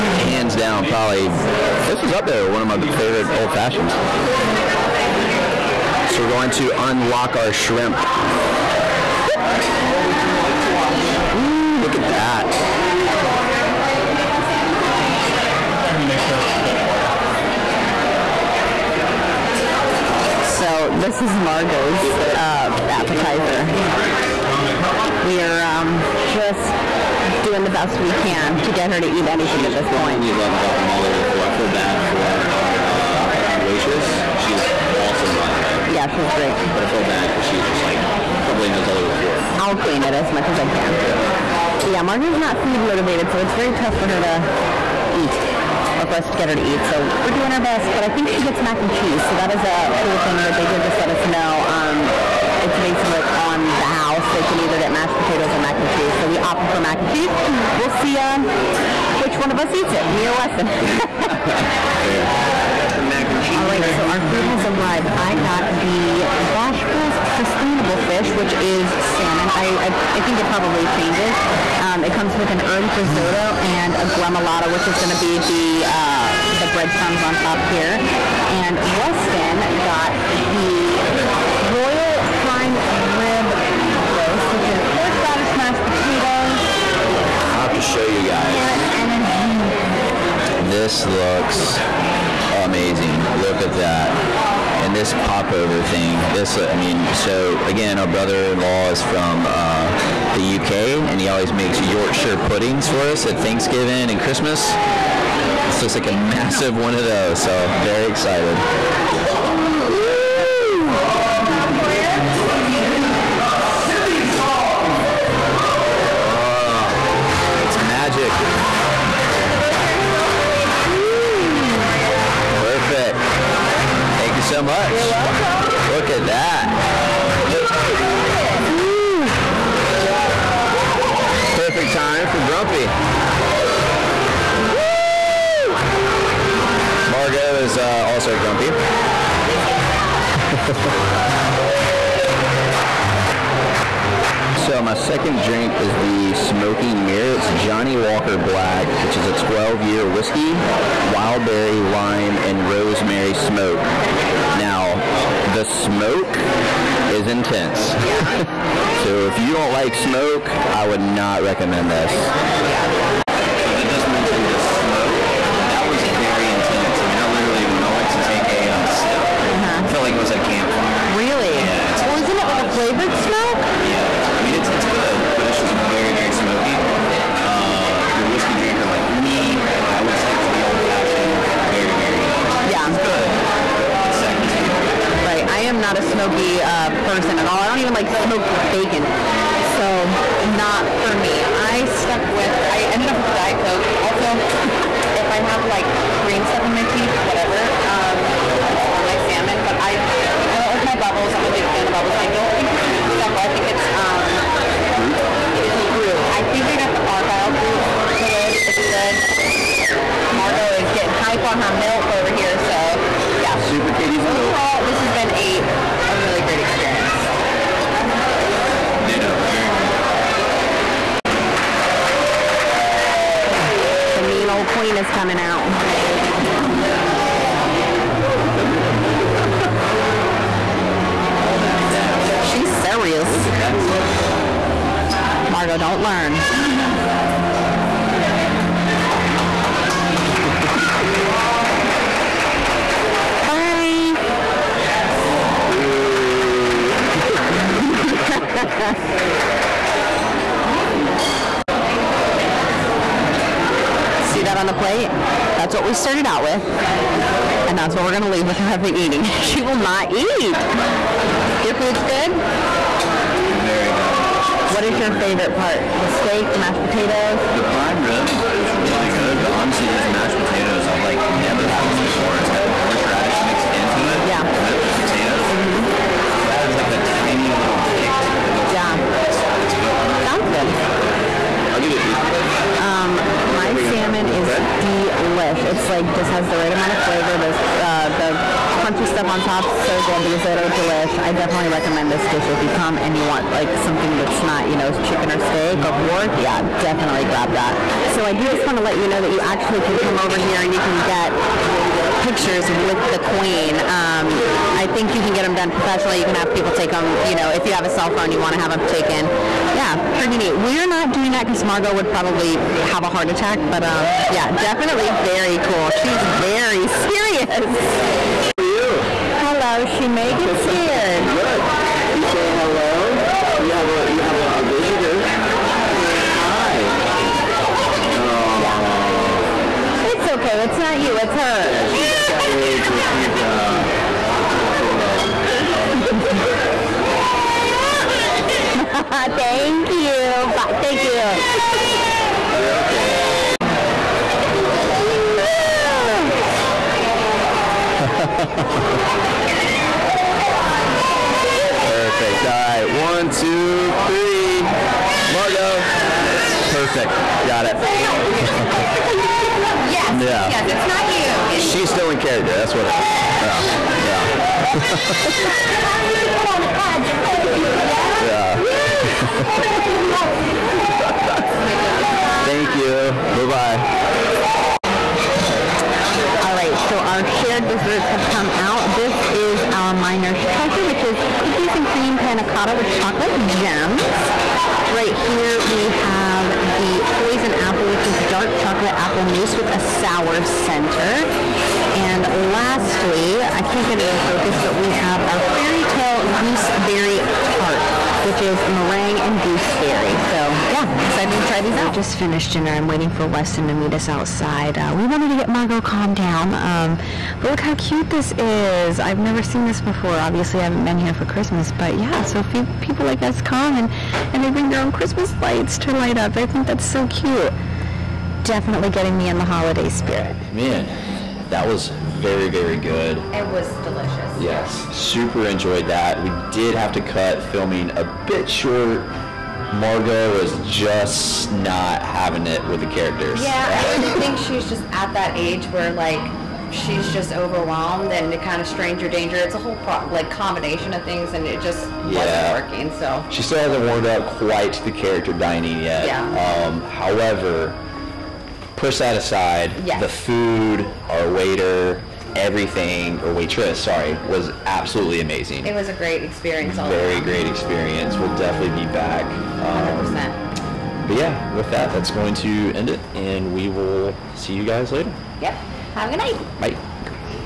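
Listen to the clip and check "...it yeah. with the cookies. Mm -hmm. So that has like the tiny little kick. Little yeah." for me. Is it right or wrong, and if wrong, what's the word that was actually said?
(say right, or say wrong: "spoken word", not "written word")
wrong: "potatoes", not "cookies".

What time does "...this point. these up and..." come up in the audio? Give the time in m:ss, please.
0:29.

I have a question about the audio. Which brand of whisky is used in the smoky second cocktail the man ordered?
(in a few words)
Johnnie Walker Black.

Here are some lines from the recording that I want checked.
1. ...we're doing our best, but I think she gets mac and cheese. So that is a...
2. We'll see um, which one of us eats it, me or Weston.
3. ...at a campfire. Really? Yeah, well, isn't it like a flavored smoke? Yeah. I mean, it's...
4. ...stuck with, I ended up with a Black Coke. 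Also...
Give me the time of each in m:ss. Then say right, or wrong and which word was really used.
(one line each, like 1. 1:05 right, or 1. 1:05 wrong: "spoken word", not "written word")
1. 0:47 right
2. 0:57 right
3. 2:50 right
4. 3:12 wrong: "Diet", not "Black".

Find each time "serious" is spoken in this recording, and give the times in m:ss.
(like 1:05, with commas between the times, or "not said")
3:52, 5:17.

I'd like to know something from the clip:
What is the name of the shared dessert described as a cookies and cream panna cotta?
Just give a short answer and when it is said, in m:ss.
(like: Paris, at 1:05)
Miner's Treasure, at 6:19.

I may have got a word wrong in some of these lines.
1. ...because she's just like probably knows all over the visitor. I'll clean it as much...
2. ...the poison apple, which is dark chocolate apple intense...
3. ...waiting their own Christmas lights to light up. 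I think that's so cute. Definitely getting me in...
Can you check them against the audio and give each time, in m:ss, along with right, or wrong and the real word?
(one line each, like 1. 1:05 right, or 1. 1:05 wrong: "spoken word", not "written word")
1. 0:37 wrong: "floor", not "visitor"
2. 6:26 wrong: "mousse", not "intense"
3. 6:54 wrong: "bring", not "waiting".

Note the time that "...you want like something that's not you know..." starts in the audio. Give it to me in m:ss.
4:53.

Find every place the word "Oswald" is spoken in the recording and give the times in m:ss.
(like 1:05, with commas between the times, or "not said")
not said.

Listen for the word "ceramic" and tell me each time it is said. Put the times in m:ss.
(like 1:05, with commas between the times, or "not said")
not said.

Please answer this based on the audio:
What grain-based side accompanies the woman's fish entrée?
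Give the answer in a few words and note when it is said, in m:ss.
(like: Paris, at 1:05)
herb risotto, at 1:12.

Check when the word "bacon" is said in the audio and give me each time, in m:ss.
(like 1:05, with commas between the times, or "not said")
3:08.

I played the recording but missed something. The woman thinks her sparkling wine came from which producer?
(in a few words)
Argyle.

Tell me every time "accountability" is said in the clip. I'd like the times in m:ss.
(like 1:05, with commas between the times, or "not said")
not said.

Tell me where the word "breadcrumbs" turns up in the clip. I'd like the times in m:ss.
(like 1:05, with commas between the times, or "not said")
1:16.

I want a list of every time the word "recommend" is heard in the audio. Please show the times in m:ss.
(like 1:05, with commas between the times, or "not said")
2:41, 4:51.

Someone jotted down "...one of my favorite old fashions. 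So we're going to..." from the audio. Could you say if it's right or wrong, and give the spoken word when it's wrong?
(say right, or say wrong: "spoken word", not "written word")
right.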